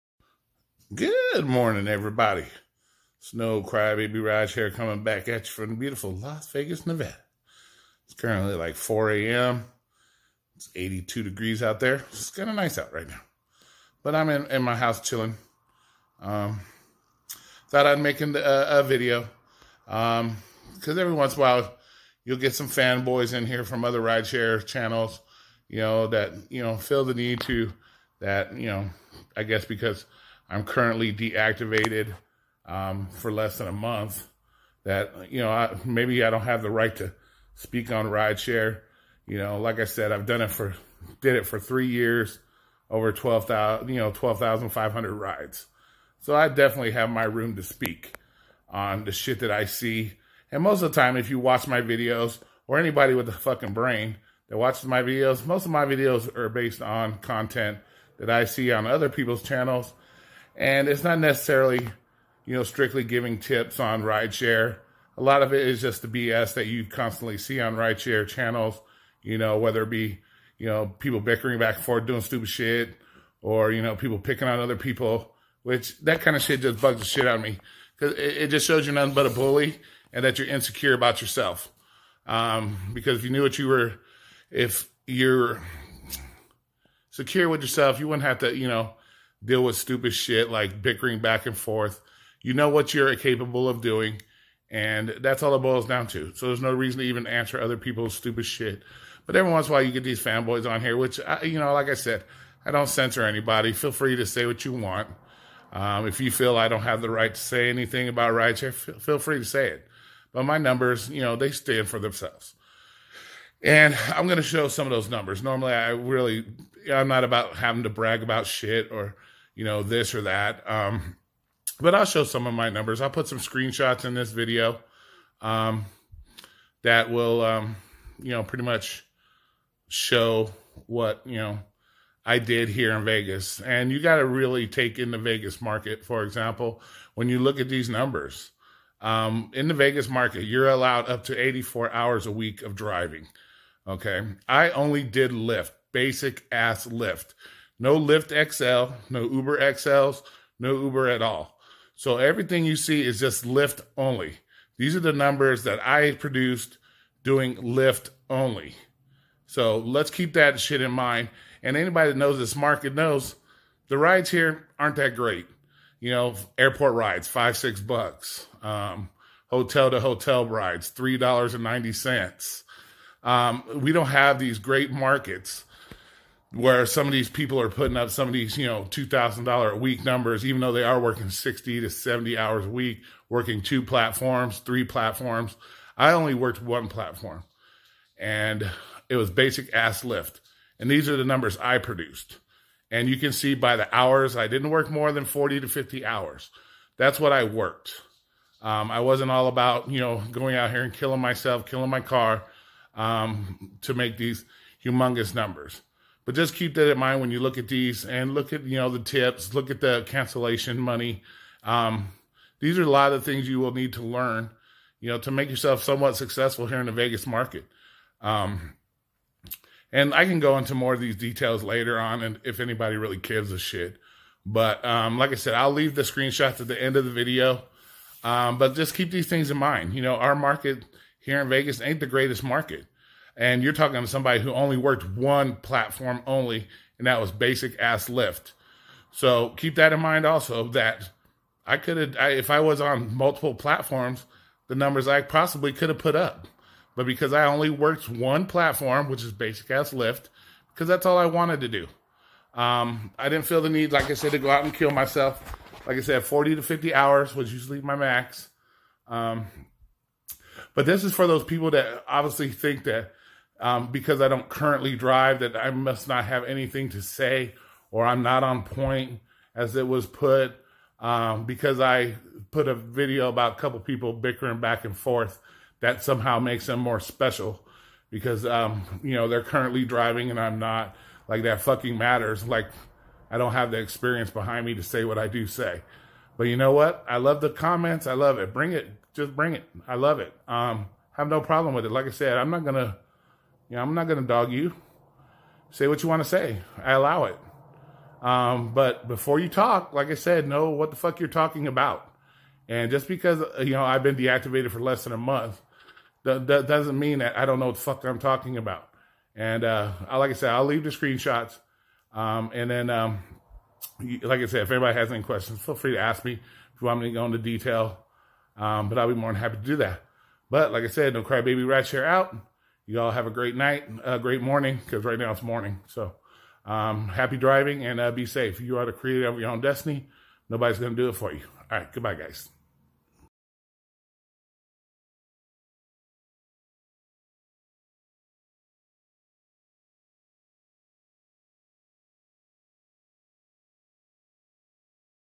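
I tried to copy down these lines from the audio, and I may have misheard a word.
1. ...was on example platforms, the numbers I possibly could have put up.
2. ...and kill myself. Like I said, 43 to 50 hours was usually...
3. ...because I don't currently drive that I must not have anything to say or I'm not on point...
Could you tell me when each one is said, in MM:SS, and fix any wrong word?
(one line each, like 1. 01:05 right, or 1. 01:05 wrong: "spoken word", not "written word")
1. 04:02 wrong: "multiple", not "example"
2. 04:14 wrong: "40", not "43"
3. 04:23 right.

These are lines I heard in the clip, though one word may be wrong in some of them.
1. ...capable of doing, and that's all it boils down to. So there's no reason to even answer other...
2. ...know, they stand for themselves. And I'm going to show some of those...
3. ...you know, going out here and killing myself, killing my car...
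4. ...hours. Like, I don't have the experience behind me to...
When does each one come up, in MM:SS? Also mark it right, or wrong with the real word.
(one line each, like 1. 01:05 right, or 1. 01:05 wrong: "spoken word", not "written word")
1. 01:33 right
2. 01:51 right
3. 03:19 right
4. 04:41 wrong: "matters", not "hours".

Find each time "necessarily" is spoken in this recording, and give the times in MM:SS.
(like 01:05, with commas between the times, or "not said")
01:01.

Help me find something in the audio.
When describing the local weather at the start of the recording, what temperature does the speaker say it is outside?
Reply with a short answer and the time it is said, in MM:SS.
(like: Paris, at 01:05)
82 degrees, at 00:10.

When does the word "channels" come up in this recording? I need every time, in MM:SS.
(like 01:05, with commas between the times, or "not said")
00:24, 00:59, 01:08.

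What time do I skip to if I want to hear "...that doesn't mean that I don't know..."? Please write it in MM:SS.
05:06.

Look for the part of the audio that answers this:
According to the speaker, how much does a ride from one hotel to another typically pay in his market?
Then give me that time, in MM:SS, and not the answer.
02:50.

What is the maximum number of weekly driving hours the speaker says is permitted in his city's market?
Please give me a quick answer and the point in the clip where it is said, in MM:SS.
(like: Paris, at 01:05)
84 hours, at 02:21.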